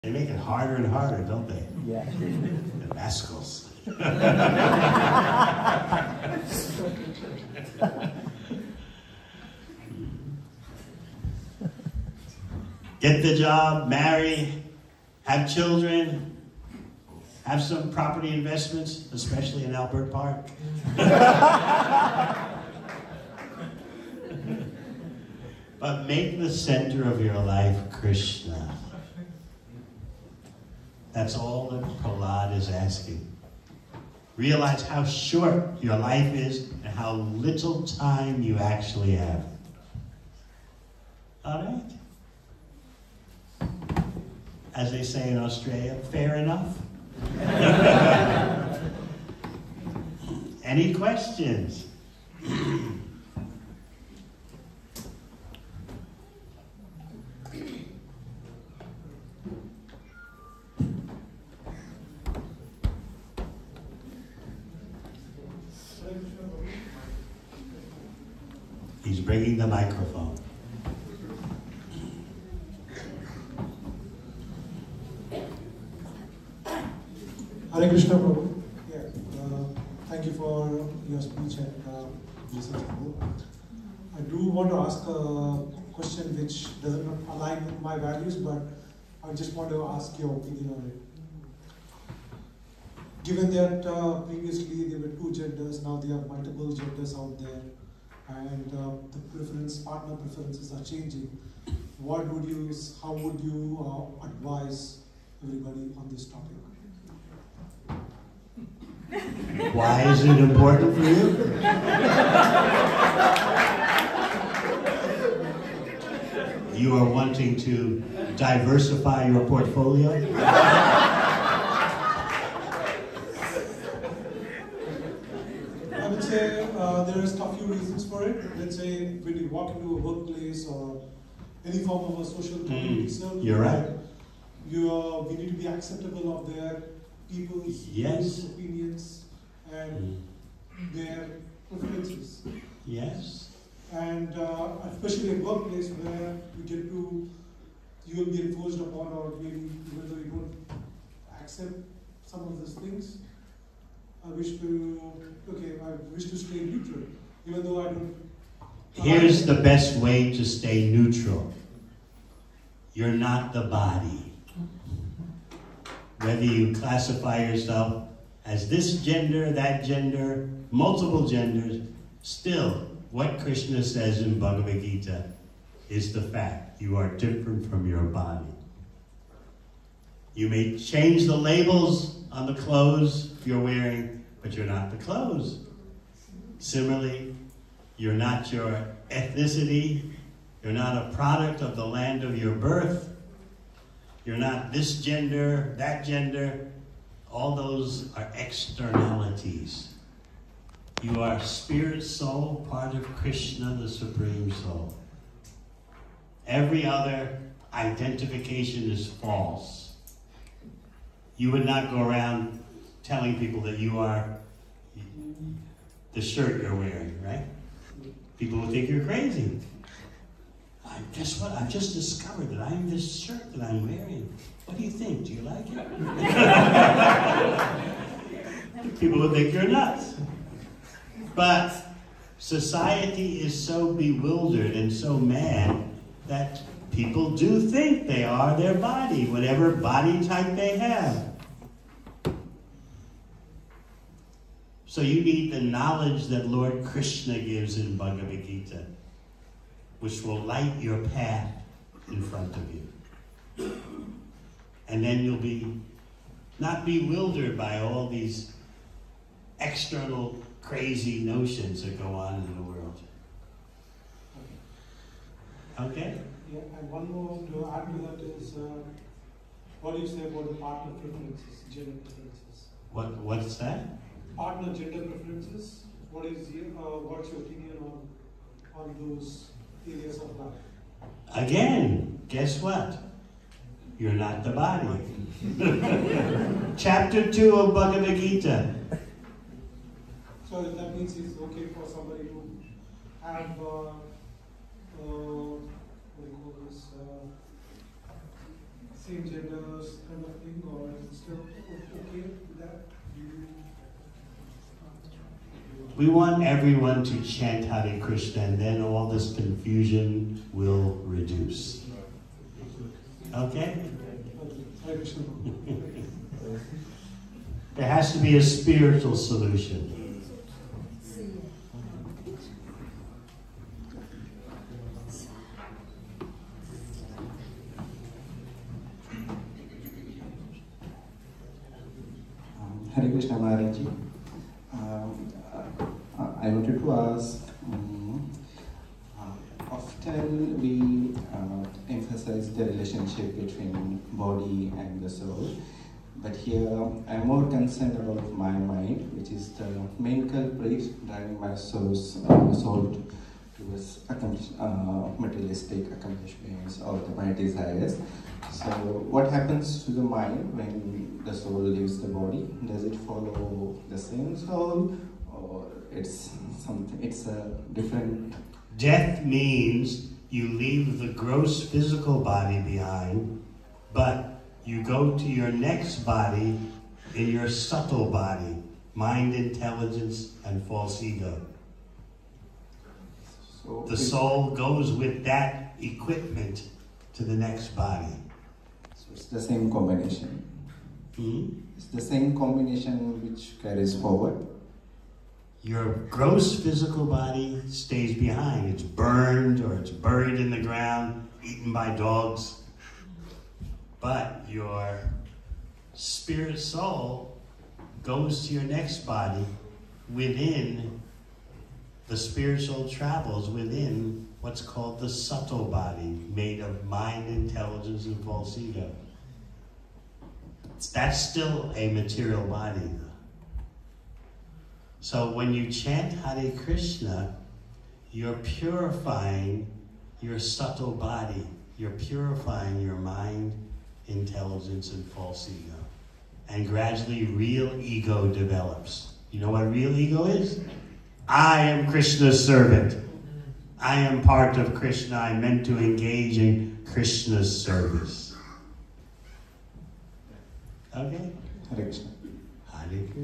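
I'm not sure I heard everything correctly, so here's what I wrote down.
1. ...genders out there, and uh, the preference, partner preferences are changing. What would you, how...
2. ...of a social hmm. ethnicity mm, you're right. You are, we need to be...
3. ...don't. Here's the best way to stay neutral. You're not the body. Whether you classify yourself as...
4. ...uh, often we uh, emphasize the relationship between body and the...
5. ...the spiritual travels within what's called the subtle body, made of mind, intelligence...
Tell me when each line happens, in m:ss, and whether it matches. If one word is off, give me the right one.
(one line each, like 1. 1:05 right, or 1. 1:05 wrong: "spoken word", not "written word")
1. 1:36 right
2. 2:12 wrong: "community", not "ethnicity"
3. 2:37 right
4. 5:39 right
5. 6:52 right.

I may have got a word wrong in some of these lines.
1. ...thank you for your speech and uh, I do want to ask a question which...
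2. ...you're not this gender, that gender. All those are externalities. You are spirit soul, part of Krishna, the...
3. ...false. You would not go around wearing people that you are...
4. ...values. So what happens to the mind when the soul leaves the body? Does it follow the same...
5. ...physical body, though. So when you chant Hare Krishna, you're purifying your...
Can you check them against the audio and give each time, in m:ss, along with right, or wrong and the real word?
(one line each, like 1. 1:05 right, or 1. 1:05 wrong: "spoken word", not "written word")
1. 1:20 right
2. 3:14 right
3. 3:29 wrong: "telling", not "wearing"
4. 5:57 wrong: "desires", not "values"
5. 7:01 wrong: "material", not "physical".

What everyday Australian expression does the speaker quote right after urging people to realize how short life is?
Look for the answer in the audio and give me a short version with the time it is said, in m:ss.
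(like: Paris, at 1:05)
fair enough, at 0:46.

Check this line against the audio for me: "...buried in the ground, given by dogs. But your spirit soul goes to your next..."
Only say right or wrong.
wrong.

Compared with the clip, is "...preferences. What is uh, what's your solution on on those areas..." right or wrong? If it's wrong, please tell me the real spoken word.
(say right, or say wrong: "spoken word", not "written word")
wrong: "opinion", not "solution".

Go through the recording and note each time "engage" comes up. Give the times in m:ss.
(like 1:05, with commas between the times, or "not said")
7:25.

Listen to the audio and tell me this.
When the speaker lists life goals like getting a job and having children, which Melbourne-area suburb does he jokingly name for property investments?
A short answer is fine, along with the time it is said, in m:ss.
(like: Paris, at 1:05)
Albert Park, at 0:19.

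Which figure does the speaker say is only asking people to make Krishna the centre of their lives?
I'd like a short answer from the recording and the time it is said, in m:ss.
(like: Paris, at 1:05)
Prahlad, at 0:32.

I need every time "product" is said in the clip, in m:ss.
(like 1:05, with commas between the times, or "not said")
3:11.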